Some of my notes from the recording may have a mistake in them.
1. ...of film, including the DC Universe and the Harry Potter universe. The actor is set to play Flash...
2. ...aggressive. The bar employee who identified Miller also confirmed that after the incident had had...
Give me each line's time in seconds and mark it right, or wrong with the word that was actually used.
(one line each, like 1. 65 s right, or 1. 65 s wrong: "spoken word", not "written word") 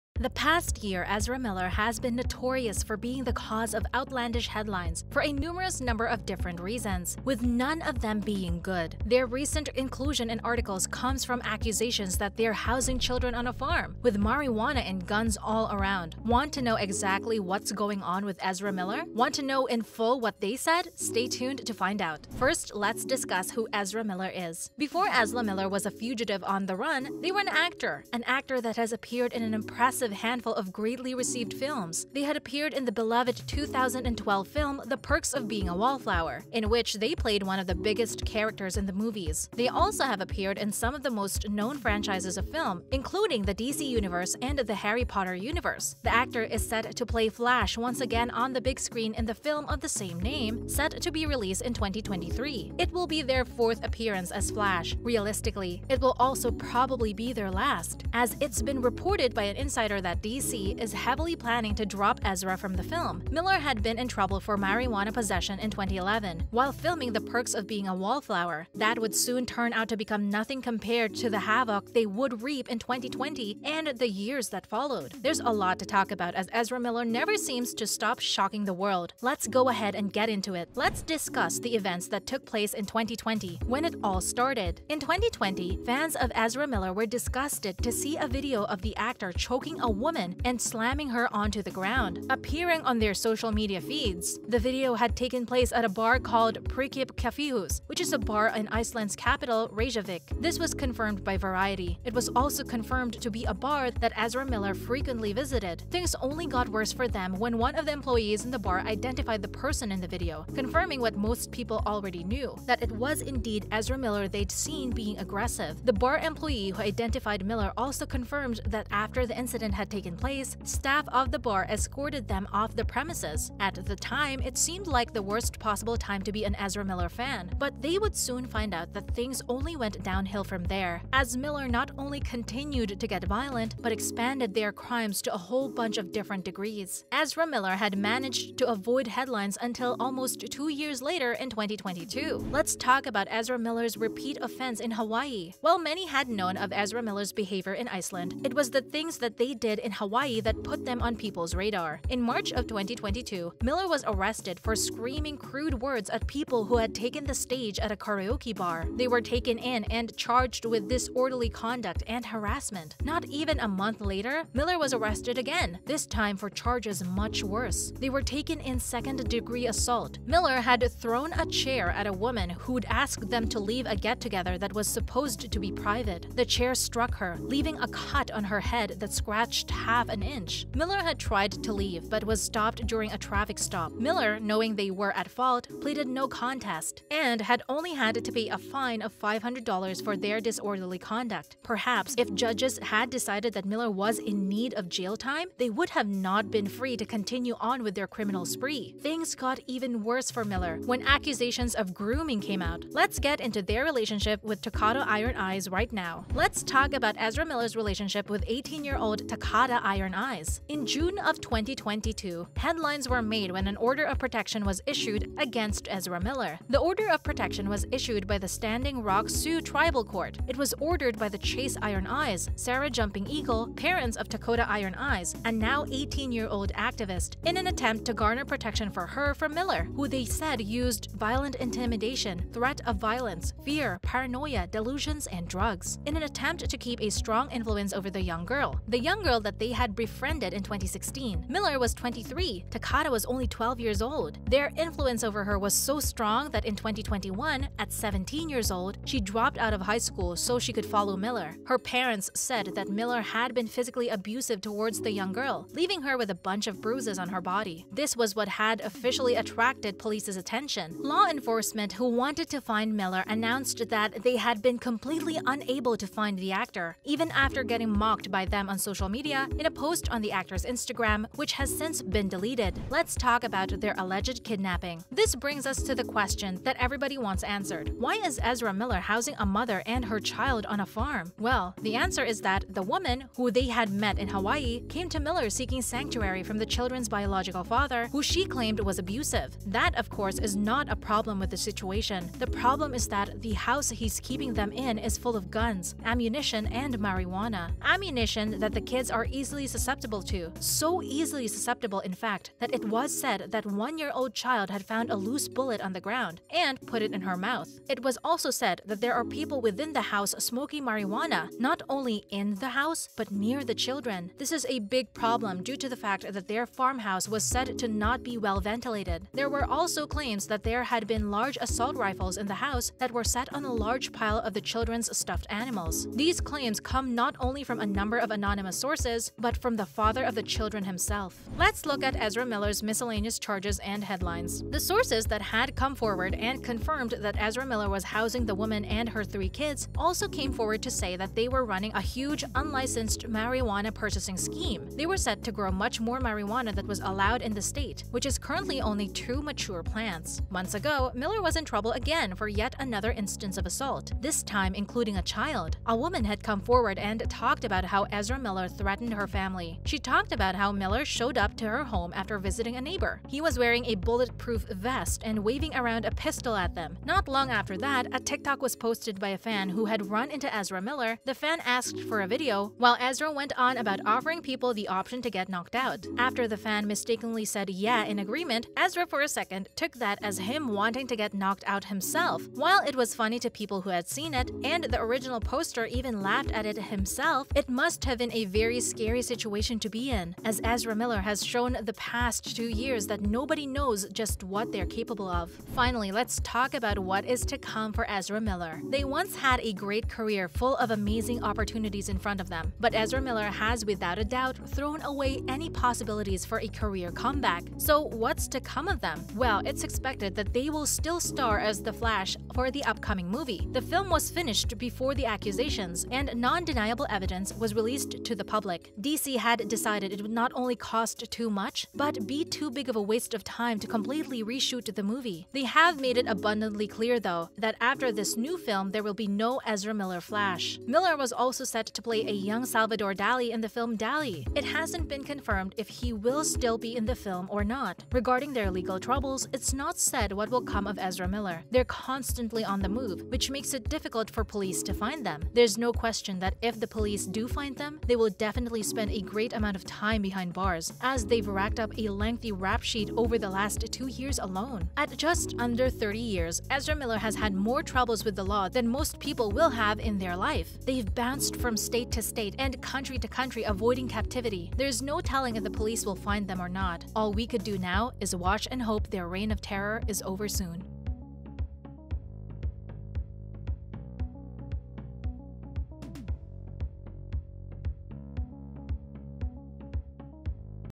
1. 42 s right
2. 115 s right.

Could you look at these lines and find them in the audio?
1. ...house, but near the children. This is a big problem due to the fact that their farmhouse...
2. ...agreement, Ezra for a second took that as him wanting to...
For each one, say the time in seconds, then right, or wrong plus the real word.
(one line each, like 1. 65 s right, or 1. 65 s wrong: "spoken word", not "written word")
1. 312 s right
2. 378 s right.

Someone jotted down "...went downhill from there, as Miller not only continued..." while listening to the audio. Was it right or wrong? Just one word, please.
right.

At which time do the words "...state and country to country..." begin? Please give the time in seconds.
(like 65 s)
462 s.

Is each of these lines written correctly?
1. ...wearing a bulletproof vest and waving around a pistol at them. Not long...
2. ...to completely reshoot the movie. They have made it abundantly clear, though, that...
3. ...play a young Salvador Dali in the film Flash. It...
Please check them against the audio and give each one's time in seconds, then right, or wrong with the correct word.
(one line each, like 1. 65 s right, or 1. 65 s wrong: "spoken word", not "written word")
1. 363 s right
2. 423 s right
3. 432 s wrong: "Dali", not "Flash".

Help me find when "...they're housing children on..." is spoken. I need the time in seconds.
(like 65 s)
12 s.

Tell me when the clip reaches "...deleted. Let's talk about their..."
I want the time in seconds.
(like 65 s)
272 s.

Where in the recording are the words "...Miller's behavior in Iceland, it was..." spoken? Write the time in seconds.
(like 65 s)
147 s.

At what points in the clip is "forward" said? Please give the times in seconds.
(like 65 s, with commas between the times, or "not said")
335 s, 340 s, 356 s.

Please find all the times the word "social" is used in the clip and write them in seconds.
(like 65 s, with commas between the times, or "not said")
93 s, 268 s.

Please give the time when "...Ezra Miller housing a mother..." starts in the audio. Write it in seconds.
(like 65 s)
278 s.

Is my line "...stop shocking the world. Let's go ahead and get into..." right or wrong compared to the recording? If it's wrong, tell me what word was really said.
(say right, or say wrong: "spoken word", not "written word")
right.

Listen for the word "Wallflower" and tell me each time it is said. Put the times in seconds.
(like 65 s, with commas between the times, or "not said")
35 s, 67 s.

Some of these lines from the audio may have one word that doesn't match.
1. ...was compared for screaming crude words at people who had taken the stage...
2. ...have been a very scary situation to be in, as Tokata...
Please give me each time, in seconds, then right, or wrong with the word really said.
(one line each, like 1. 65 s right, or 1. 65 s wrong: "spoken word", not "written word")
1. 153 s wrong: "arrested", not "compared"
2. 388 s wrong: "Ezra", not "Tokata".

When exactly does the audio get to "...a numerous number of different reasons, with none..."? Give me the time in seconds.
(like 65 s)
5 s.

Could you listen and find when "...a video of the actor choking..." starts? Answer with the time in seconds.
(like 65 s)
88 s.